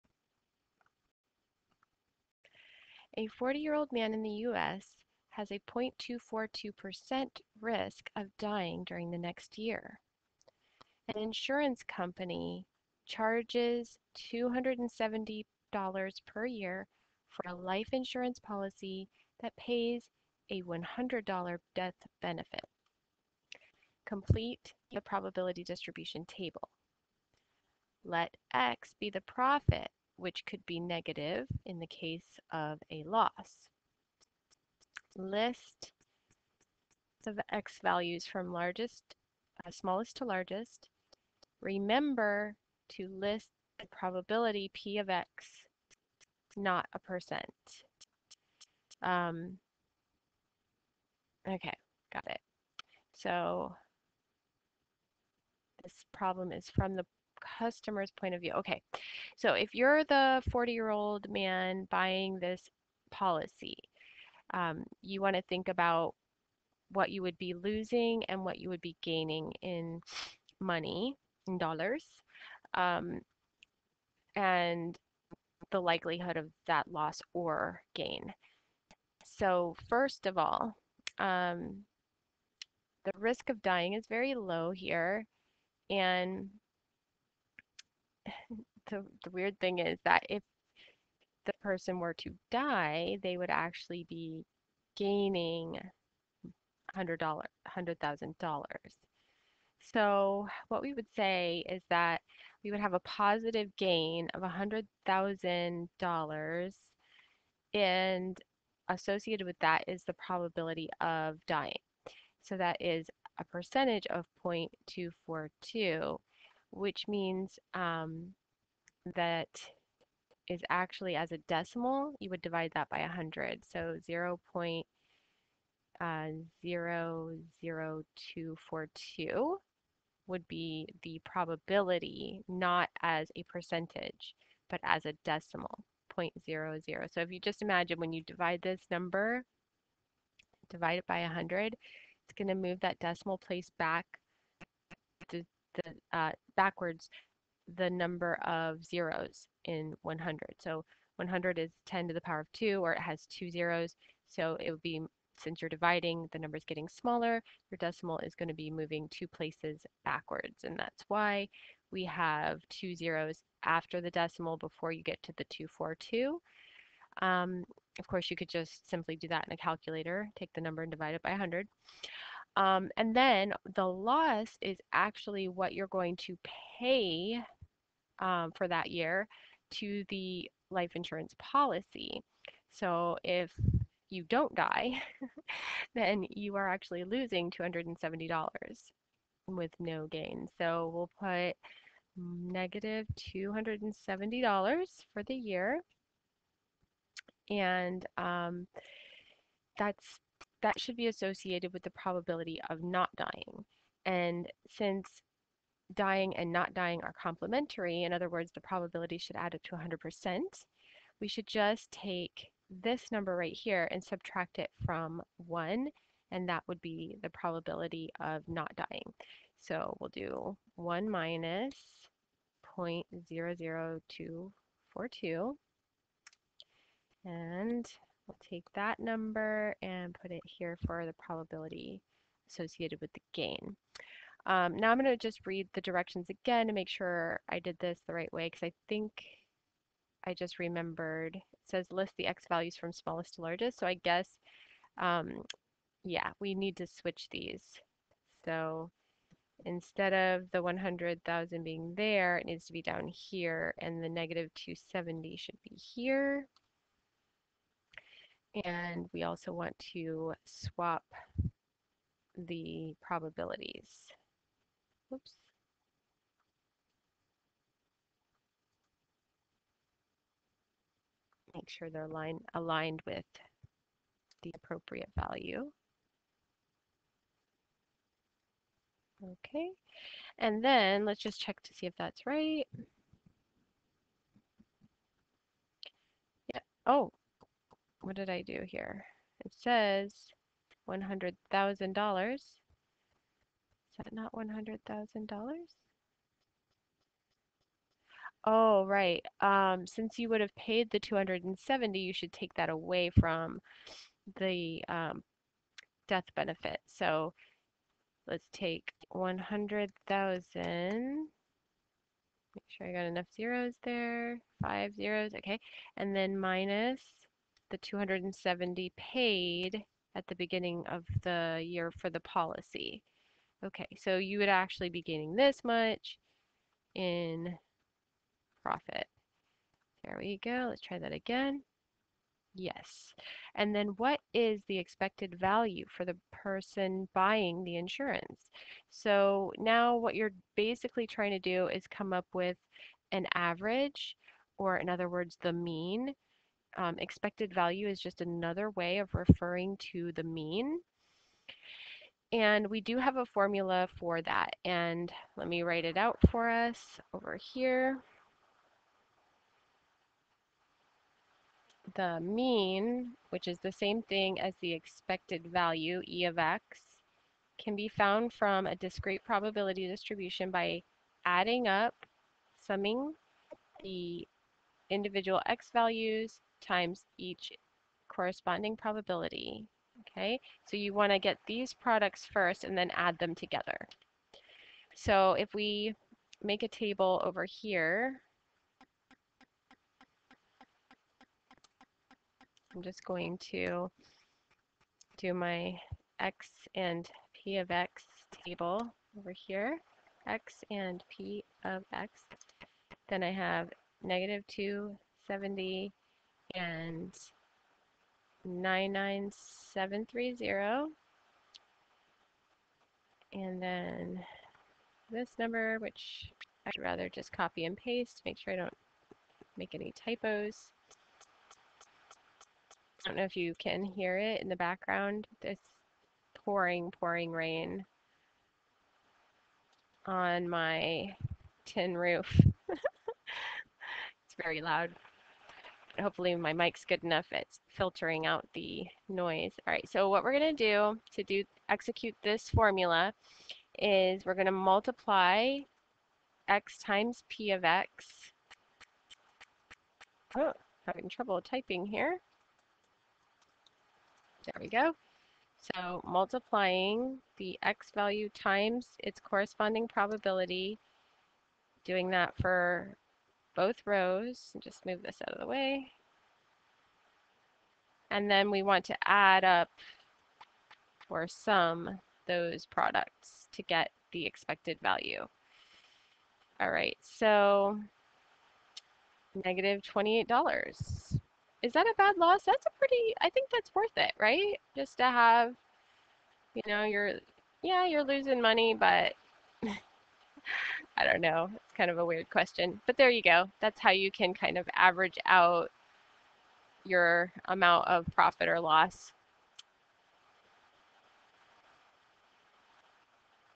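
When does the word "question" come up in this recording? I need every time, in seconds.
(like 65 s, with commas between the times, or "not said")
492 s.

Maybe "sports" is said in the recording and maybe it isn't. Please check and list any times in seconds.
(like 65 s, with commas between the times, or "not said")
not said.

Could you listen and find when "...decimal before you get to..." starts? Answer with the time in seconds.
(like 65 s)
164 s.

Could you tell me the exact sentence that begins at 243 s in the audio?
So I guess, um, yeah, we need to switch these.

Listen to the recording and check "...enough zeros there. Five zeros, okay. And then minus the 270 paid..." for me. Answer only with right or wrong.
right.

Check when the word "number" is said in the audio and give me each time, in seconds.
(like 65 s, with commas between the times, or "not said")
138 s, 147 s, 156 s, 170 s, 213 s, 228 s, 415 s.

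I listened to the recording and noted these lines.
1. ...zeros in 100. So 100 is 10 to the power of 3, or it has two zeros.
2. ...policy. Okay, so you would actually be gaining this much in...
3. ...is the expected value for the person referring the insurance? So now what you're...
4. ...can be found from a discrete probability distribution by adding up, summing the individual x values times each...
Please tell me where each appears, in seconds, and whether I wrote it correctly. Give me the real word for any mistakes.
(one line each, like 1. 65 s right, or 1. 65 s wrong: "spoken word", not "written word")
1. 148 s wrong: "2", not "3"
2. 322 s right
3. 334 s wrong: "buying", not "referring"
4. 367 s right.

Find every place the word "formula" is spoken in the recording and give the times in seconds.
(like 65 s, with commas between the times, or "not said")
353 s, 442 s.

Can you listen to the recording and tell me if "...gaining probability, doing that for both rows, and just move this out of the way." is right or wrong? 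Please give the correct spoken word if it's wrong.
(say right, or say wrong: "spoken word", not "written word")
wrong: "corresponding", not "gaining".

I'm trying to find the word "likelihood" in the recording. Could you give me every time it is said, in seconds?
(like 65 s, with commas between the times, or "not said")
75 s.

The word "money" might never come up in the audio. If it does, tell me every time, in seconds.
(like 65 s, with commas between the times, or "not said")
70 s, 488 s.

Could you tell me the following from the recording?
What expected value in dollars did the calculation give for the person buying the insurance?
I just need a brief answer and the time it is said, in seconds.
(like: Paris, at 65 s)
-$28, at 479 s.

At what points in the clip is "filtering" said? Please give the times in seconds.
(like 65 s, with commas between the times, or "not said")
437 s.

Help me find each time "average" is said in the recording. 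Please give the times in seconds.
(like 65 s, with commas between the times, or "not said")
343 s, 494 s.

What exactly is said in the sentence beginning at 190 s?
So we'll put negative $270 for the year.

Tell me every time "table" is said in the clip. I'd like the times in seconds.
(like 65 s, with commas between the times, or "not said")
26 s, 386 s, 398 s.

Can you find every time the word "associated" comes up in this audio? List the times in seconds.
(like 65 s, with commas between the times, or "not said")
108 s, 201 s, 232 s.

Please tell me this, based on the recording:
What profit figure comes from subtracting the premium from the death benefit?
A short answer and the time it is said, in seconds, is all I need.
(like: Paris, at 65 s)
99730, at 408 s.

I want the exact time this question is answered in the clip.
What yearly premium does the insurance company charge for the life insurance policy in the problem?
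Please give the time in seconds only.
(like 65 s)
14 s.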